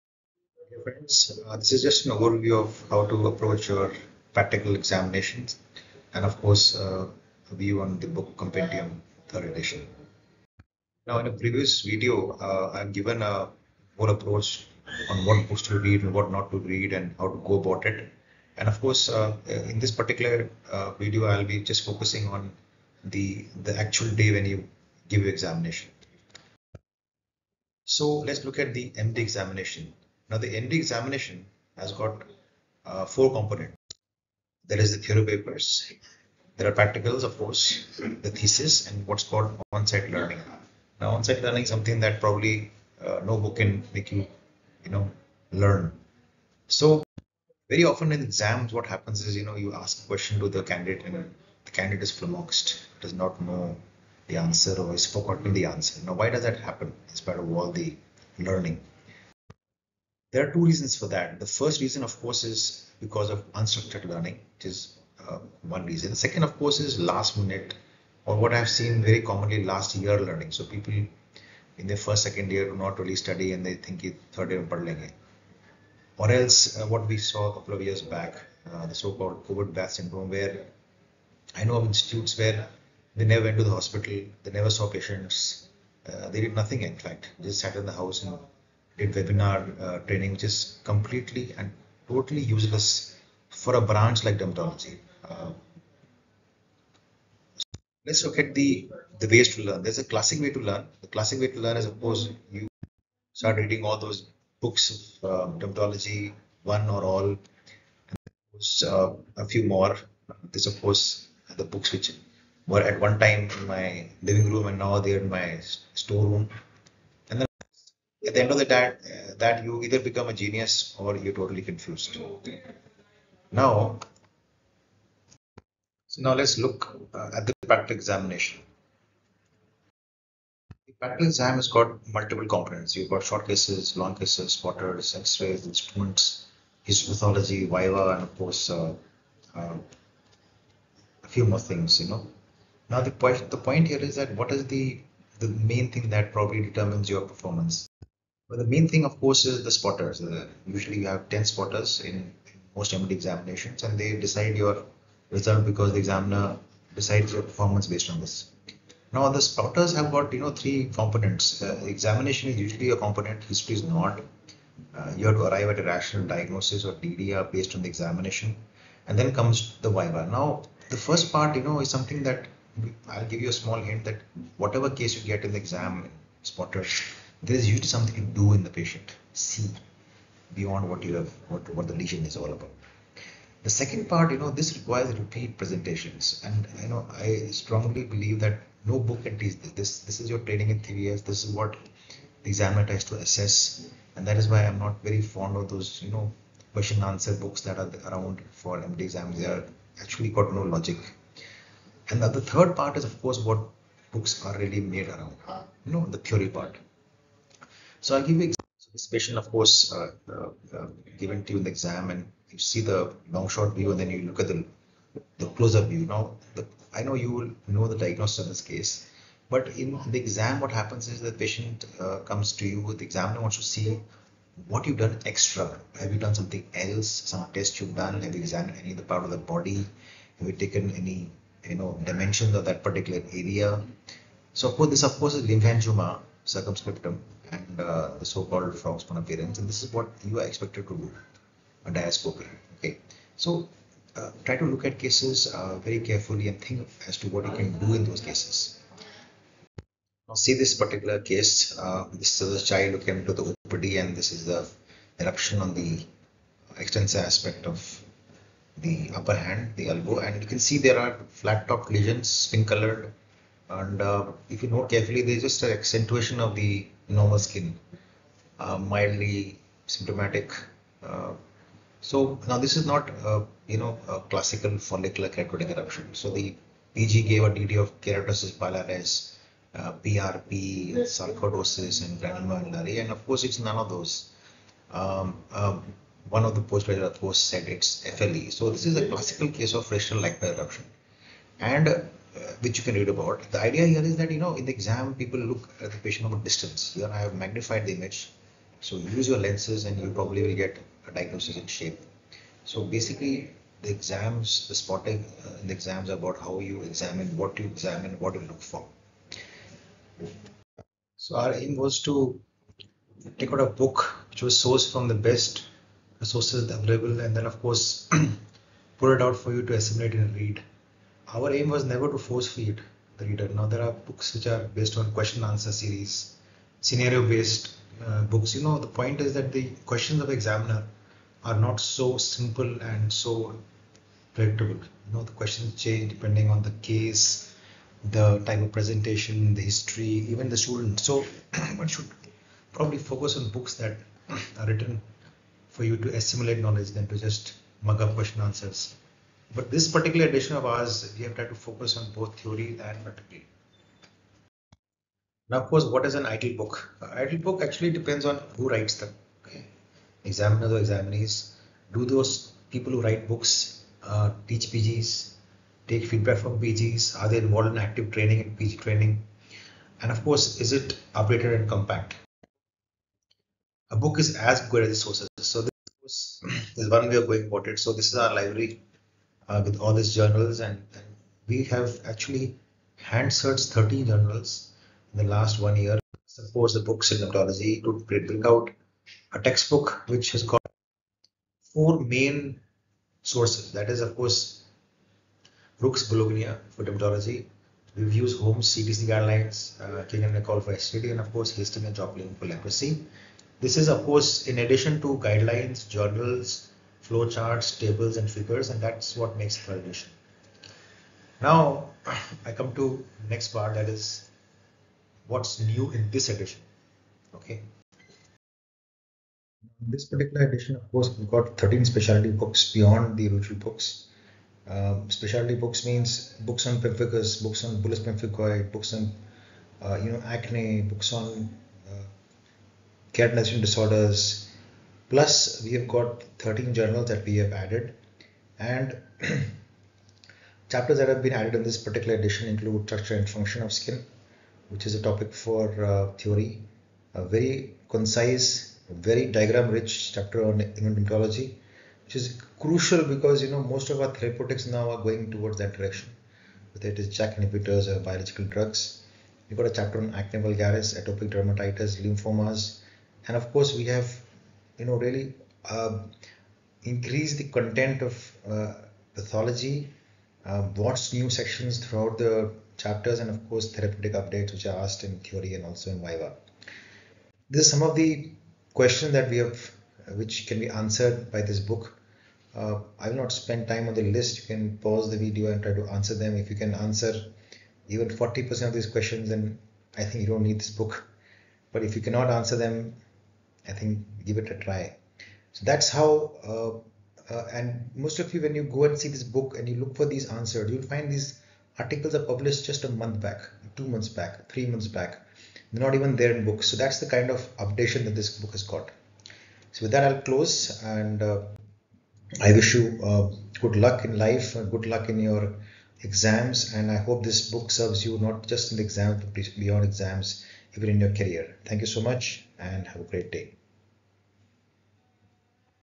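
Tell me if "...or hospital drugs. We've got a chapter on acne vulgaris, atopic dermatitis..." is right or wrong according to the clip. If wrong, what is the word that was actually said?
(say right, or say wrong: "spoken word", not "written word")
wrong: "biological", not "hospital".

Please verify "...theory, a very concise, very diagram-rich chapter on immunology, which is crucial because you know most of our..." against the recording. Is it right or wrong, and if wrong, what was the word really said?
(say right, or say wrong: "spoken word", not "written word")
right.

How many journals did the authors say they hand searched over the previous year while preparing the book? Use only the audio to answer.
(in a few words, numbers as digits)
30.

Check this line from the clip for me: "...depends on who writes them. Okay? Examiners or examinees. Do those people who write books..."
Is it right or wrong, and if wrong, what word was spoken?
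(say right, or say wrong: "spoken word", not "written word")
right.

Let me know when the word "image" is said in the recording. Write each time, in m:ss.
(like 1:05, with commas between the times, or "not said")
4:57.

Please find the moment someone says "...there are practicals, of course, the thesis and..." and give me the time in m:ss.
0:36.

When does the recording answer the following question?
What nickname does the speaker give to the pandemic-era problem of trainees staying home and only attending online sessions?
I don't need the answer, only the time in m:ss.
1:19.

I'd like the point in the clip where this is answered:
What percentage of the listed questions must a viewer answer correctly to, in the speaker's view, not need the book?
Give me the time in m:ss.
8:08.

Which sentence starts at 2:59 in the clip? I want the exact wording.
See beyond what you have, what, what the lesion is all about.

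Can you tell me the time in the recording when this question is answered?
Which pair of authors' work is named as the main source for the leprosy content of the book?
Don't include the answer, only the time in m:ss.
6:41.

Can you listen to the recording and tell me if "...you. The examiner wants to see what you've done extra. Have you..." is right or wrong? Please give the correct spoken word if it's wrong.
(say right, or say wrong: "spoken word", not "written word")
right.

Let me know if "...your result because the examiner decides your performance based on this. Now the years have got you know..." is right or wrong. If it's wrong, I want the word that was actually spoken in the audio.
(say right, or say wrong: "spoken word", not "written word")
wrong: "spotters", not "years".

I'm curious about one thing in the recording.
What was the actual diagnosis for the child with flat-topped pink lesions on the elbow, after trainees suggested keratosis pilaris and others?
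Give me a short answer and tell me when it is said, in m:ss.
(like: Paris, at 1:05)
Frictional lichenoid eruption, at 4:49.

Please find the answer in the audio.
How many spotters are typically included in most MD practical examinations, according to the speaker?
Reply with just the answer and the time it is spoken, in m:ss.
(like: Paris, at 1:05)
10, at 2:31.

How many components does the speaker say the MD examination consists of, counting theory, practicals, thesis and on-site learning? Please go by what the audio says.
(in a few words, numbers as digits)
4.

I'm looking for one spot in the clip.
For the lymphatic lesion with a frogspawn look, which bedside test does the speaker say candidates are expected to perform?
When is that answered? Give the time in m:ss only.
4:01.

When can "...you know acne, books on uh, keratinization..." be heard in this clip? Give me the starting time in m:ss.
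7:10.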